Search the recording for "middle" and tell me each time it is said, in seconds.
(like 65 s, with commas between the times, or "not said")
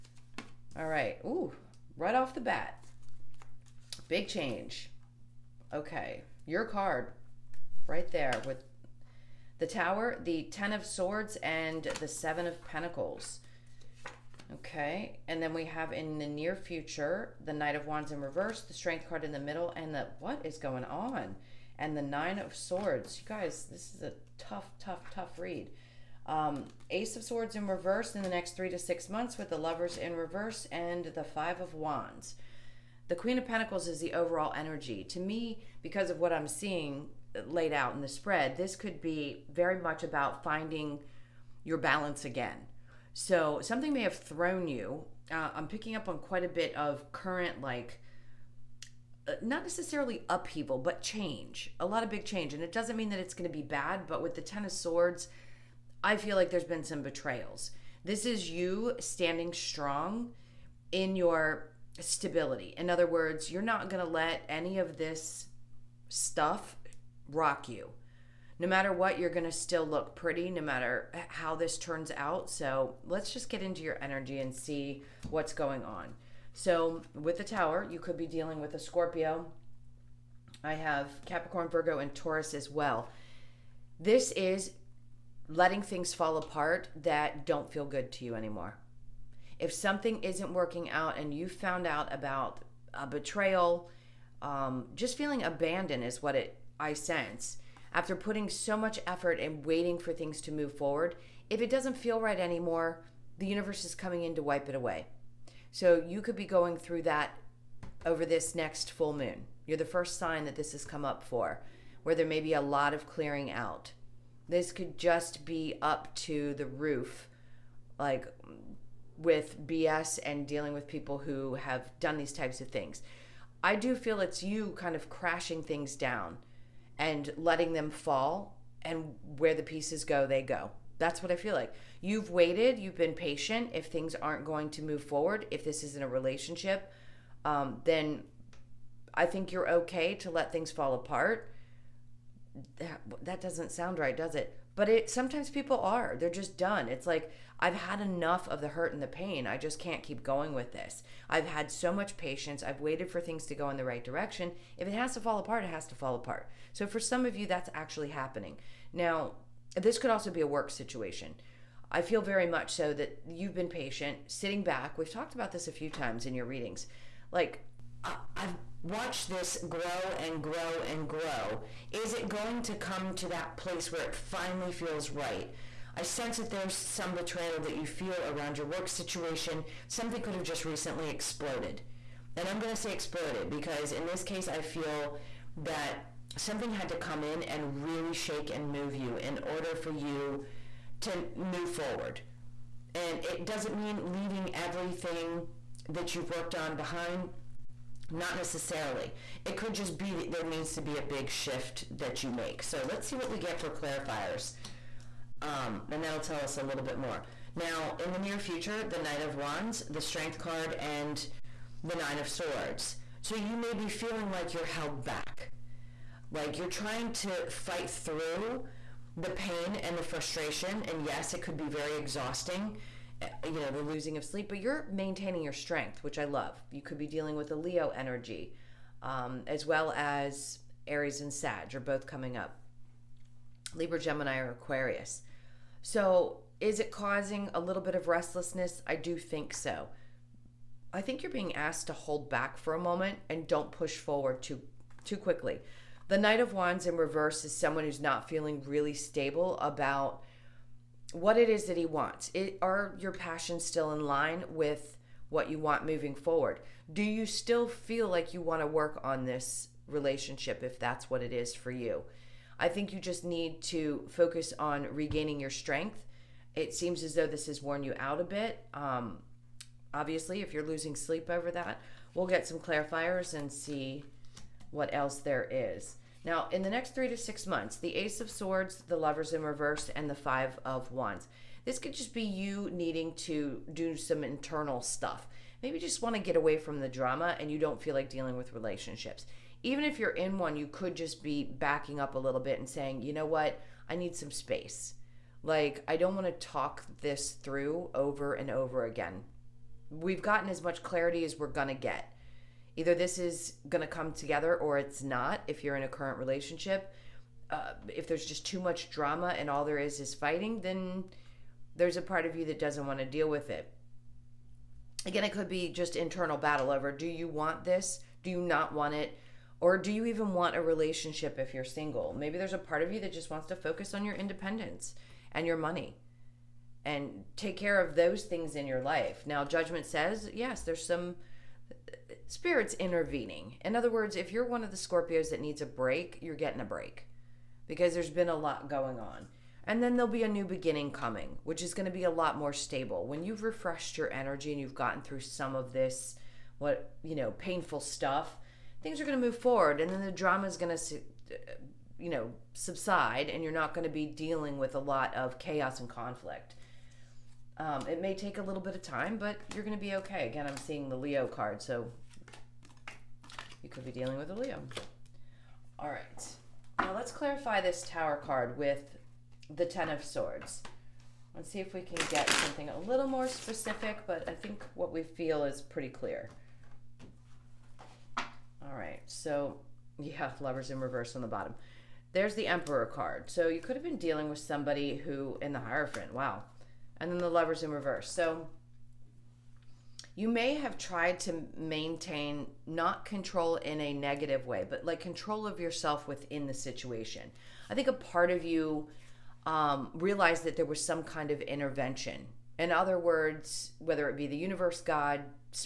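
19 s.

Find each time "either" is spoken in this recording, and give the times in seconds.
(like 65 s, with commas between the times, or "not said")
302 s.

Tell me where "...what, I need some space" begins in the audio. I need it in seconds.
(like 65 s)
293 s.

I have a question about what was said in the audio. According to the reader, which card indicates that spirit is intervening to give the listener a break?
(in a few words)
Judgment.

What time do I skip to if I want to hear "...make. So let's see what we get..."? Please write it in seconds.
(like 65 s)
202 s.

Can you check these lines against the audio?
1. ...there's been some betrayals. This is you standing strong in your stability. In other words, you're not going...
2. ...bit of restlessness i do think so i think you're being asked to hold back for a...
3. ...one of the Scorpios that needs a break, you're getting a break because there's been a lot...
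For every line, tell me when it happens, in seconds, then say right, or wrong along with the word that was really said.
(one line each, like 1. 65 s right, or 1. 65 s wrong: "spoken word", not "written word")
1. 56 s right
2. 237 s right
3. 334 s right.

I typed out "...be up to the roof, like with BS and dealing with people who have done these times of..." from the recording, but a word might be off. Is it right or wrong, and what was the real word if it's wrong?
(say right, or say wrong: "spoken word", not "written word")
wrong: "types", not "times".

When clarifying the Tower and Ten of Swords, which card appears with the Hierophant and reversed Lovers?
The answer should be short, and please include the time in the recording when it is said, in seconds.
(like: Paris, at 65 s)
The Emperor, at 382 s.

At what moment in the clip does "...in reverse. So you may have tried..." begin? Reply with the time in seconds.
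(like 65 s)
387 s.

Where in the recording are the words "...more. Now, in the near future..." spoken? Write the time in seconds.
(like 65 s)
206 s.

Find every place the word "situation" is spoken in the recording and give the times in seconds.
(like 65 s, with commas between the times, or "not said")
160 s, 178 s, 396 s.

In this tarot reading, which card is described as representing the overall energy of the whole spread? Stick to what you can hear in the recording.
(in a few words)
Queen of Pentacles.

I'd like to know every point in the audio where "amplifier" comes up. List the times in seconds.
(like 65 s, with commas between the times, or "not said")
not said.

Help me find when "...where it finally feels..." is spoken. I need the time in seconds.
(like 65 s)
173 s.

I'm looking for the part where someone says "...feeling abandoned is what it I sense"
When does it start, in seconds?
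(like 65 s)
95 s.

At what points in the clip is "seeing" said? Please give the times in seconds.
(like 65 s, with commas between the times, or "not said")
36 s, 360 s.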